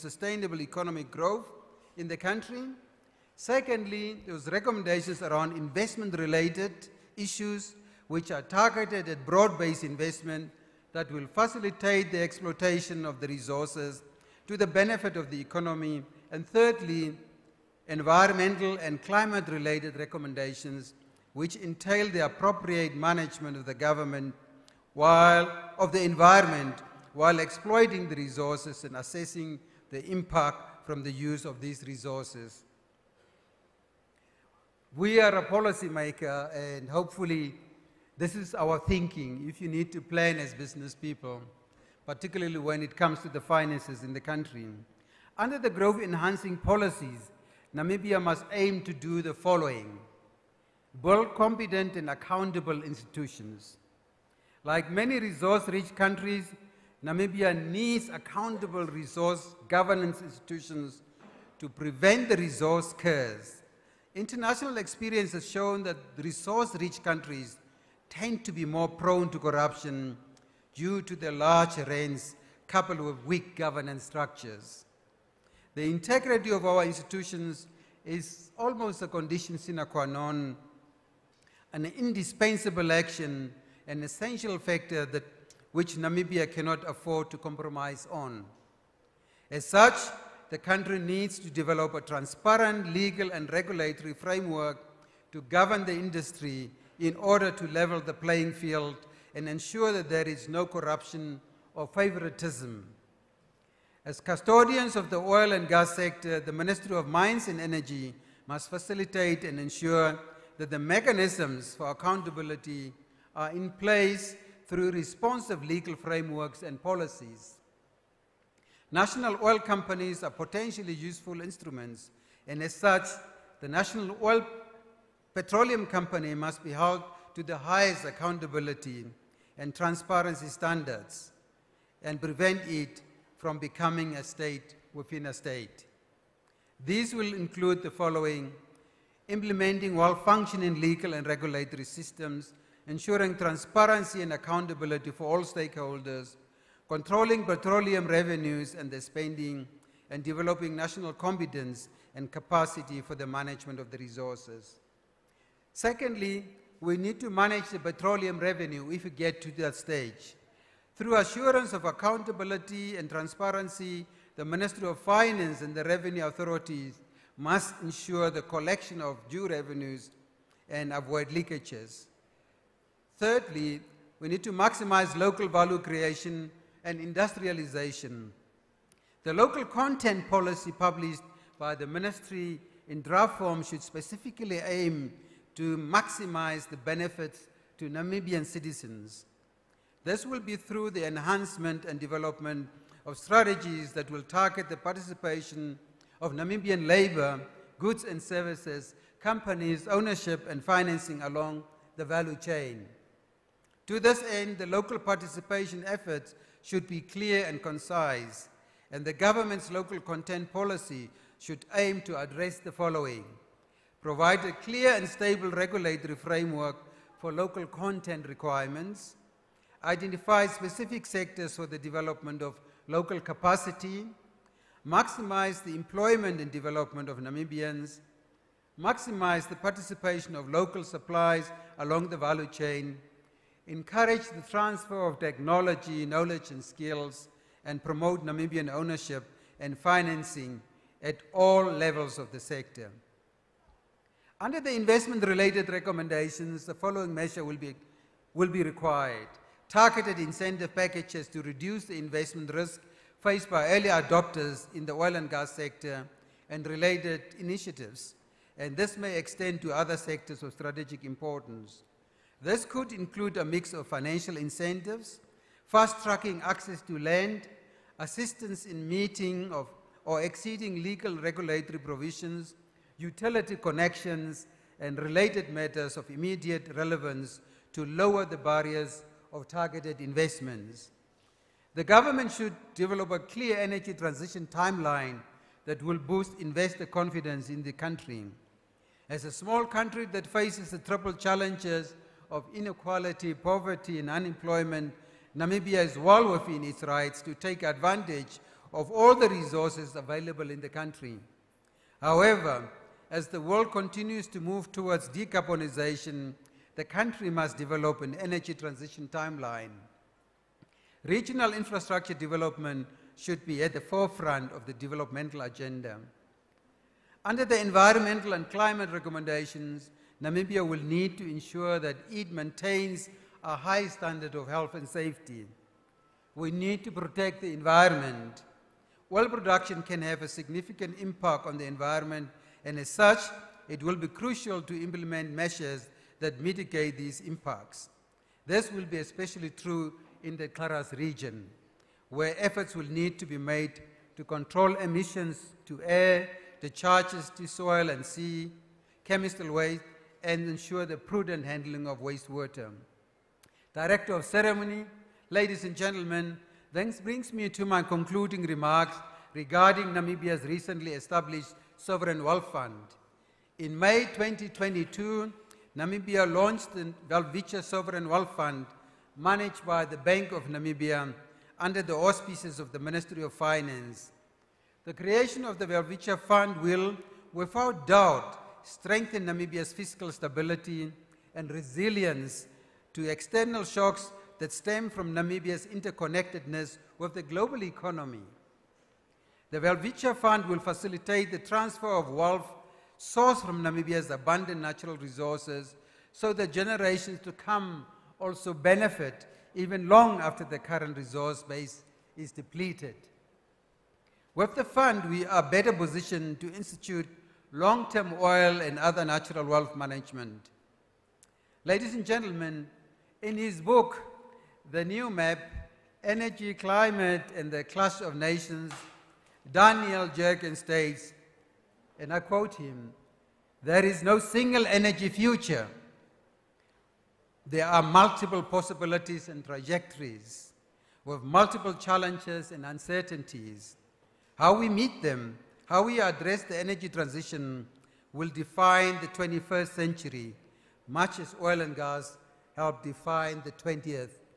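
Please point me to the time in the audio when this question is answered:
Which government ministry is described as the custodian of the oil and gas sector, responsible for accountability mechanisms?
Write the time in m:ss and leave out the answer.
1:46.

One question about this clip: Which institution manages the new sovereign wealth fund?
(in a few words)
Bank of Namibia.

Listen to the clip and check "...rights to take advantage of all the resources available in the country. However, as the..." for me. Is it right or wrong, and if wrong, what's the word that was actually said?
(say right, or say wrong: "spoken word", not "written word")
right.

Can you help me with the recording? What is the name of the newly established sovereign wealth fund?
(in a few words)
Welwitschia Sovereign Wealth Fund.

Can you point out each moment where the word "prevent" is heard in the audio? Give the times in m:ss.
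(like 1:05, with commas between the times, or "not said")
1:01, 2:12.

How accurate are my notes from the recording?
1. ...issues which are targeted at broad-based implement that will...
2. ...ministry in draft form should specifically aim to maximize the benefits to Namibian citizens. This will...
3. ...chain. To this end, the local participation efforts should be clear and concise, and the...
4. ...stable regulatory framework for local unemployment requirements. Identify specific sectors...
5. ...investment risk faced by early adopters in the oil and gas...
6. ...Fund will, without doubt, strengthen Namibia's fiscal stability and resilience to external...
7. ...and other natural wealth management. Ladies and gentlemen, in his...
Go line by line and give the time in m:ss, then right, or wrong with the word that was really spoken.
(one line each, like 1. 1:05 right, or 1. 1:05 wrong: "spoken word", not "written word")
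1. 0:07 wrong: "investment", not "implement"
2. 3:01 right
3. 3:22 right
4. 3:35 wrong: "content", not "unemployment"
5. 4:11 right
6. 6:16 right
7. 6:48 right.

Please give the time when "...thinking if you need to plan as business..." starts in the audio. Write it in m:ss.
0:38.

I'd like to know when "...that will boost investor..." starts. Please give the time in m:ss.
4:45.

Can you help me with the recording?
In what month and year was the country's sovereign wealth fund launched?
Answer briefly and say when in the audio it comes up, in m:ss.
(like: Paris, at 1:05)
May 2022, at 6:03.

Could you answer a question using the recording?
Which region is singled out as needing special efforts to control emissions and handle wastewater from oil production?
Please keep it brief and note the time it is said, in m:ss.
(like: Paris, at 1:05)
//Kharas region, at 5:40.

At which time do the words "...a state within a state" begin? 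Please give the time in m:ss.
2:14.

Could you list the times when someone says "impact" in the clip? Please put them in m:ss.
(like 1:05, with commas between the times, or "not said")
0:30, 5:30, 5:37.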